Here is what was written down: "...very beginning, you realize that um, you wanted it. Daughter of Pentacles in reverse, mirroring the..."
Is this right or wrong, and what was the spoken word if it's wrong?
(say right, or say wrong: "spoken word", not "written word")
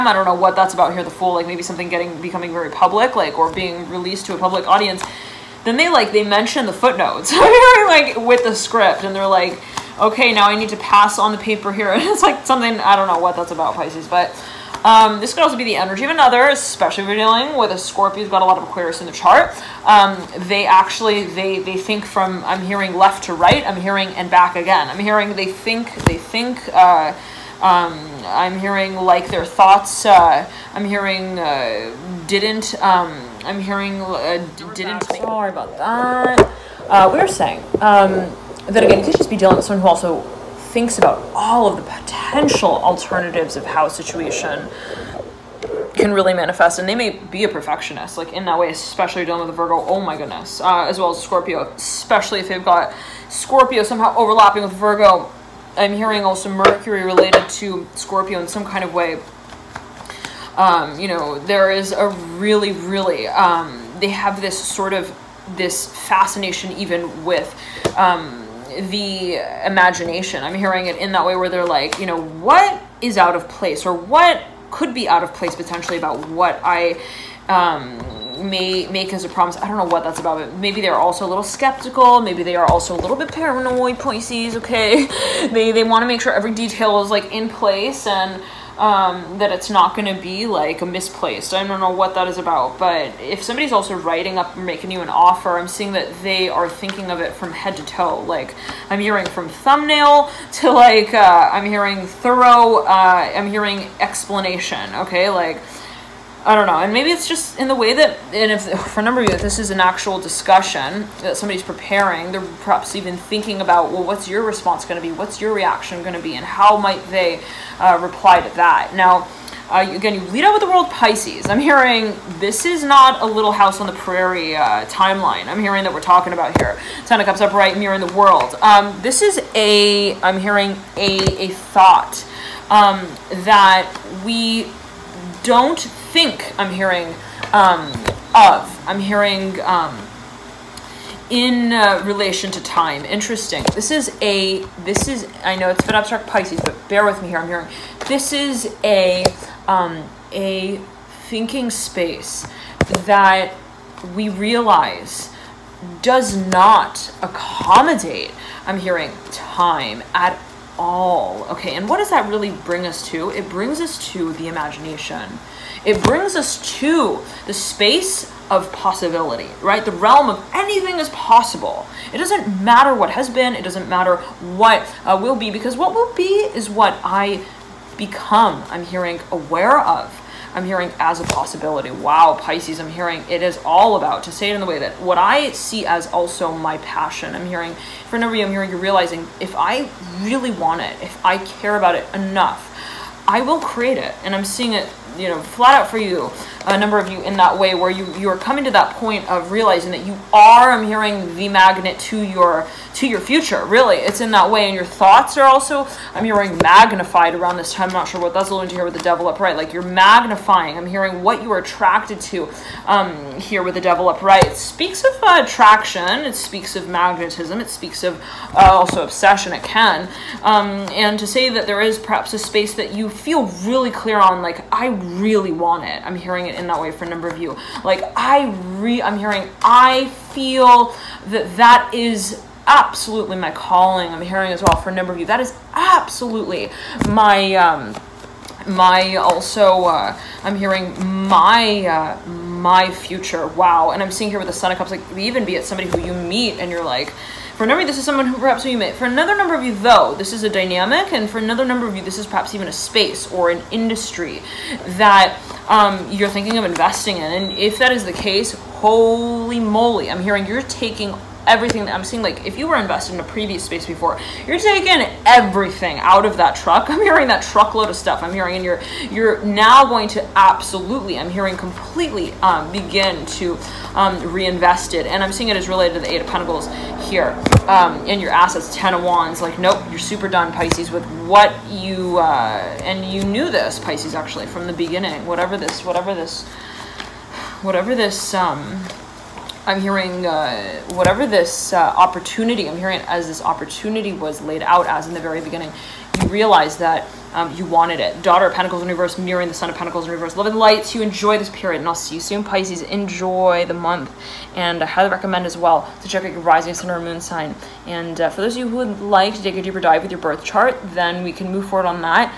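right.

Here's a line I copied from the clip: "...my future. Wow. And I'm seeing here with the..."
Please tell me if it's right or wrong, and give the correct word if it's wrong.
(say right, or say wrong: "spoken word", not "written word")
right.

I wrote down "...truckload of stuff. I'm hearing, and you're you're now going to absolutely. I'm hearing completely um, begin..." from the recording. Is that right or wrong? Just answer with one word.
right.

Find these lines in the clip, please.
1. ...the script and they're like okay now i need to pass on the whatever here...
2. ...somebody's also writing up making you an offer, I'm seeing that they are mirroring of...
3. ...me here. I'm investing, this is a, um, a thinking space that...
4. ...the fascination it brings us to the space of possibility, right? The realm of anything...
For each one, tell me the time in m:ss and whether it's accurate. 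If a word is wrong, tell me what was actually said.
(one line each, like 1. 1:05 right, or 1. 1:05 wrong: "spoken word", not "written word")
1. 0:08 wrong: "paper", not "whatever"
2. 1:33 wrong: "thinking", not "mirroring"
3. 2:27 wrong: "hearing", not "investing"
4. 2:44 wrong: "imagination", not "fascination".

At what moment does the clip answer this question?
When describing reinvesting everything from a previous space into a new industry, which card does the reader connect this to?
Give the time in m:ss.
4:36.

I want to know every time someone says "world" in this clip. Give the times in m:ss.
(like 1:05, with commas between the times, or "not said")
2:00, 2:08.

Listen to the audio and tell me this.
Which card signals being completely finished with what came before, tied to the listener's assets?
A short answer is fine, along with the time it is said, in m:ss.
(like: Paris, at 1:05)
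Ten of Wands, at 4:38.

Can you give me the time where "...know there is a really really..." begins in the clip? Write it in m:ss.
1:01.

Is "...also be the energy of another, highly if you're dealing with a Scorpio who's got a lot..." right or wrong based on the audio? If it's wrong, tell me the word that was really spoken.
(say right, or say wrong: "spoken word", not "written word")
wrong: "especially", not "highly".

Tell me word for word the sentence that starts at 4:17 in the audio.
And if that is the case, holy moly, I'm hearing you're taking everything that I'm seeing.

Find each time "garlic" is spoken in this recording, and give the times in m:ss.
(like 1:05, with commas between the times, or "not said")
not said.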